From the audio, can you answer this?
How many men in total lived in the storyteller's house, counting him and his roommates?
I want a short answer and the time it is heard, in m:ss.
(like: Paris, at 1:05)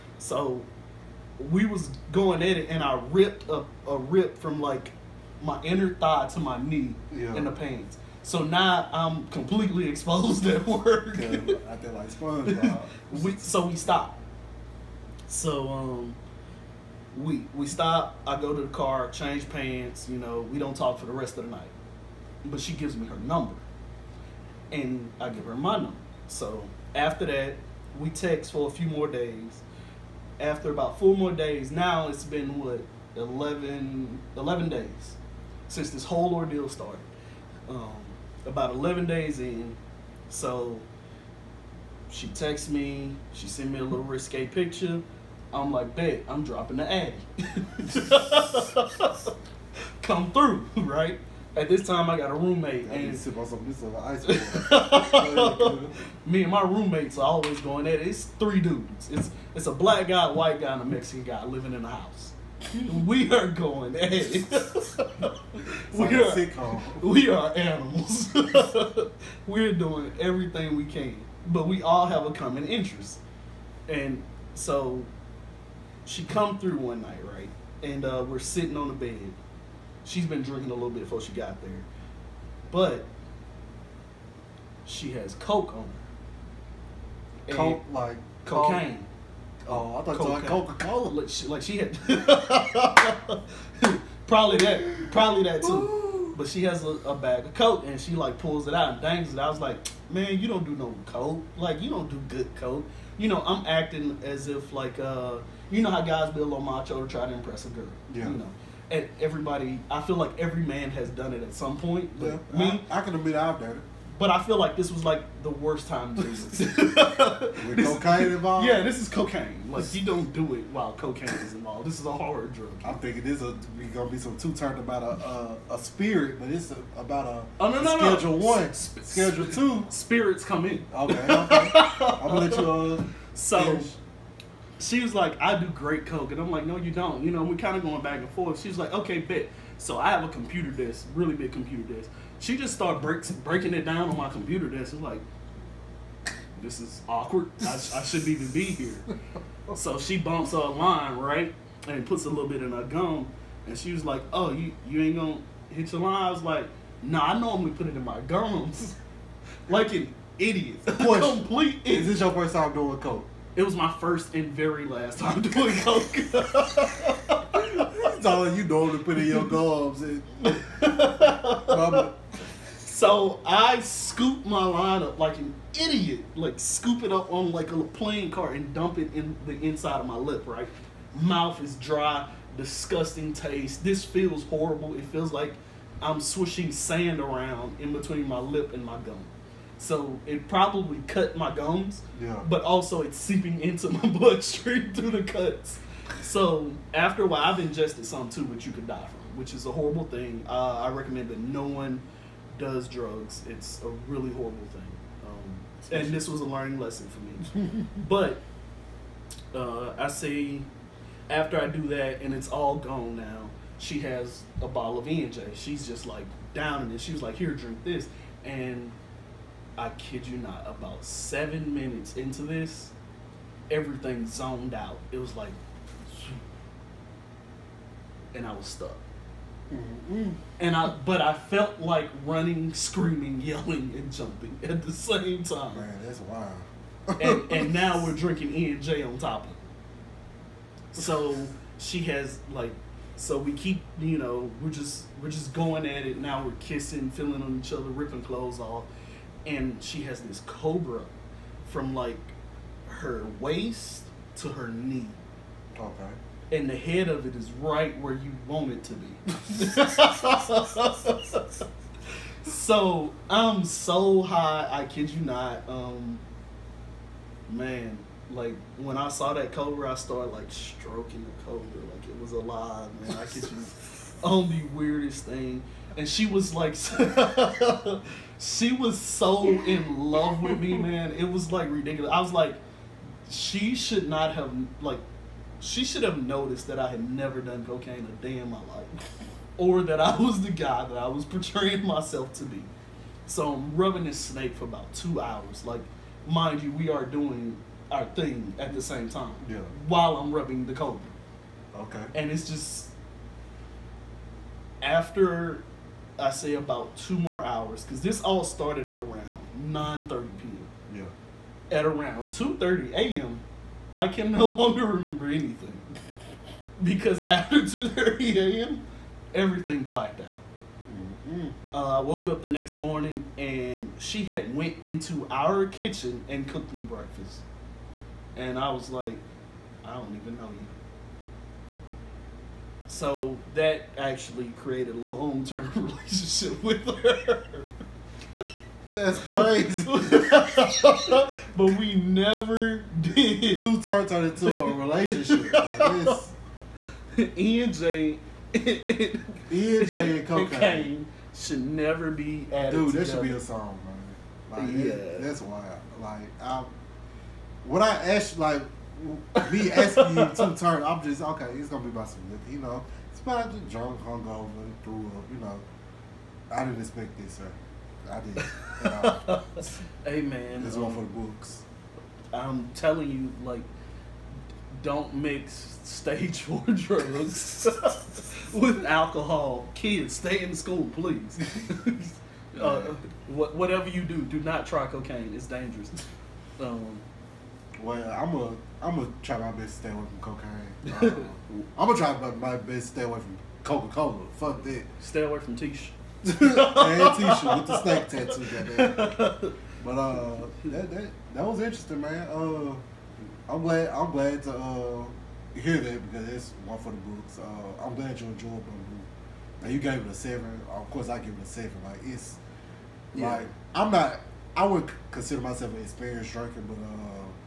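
3, at 0:58.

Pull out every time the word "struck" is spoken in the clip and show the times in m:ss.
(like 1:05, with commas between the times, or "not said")
not said.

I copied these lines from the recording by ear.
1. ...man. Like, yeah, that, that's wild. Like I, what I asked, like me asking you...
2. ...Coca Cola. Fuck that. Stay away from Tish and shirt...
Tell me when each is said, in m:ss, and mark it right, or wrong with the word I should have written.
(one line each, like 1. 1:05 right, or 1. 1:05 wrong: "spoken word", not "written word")
1. 5:53 right
2. 6:33 right.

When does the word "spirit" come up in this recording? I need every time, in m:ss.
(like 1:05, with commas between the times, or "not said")
2:05, 2:09.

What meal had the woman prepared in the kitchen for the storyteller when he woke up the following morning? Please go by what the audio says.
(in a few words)
Breakfast.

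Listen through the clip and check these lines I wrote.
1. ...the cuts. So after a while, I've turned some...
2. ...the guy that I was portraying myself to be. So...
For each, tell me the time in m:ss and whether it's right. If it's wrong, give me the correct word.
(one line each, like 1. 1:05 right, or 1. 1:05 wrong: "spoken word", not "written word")
1. 3:15 wrong: "ingested", not "turned"
2. 4:50 right.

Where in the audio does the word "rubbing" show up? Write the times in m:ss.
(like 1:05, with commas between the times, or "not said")
4:53, 5:00.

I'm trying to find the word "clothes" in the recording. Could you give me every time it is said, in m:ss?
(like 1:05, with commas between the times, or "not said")
4:08.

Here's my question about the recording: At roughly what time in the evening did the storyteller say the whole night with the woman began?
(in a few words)
9:30 p.m.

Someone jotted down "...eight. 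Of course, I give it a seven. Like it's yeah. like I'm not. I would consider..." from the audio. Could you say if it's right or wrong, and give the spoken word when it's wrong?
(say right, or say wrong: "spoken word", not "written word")
wrong: "seven", not "eight".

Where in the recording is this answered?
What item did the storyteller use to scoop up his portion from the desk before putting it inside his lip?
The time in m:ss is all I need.
2:57.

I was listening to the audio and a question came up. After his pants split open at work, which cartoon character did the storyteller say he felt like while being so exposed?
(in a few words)
SpongeBob.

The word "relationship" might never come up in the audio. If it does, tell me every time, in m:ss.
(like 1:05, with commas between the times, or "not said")
5:35, 5:44.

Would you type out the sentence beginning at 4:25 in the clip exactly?
Um, man, like when I saw that cobra, I started like stroking the cobra, like it was alive, man.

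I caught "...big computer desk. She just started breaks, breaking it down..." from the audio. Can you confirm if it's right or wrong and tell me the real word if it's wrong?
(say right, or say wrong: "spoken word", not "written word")
right.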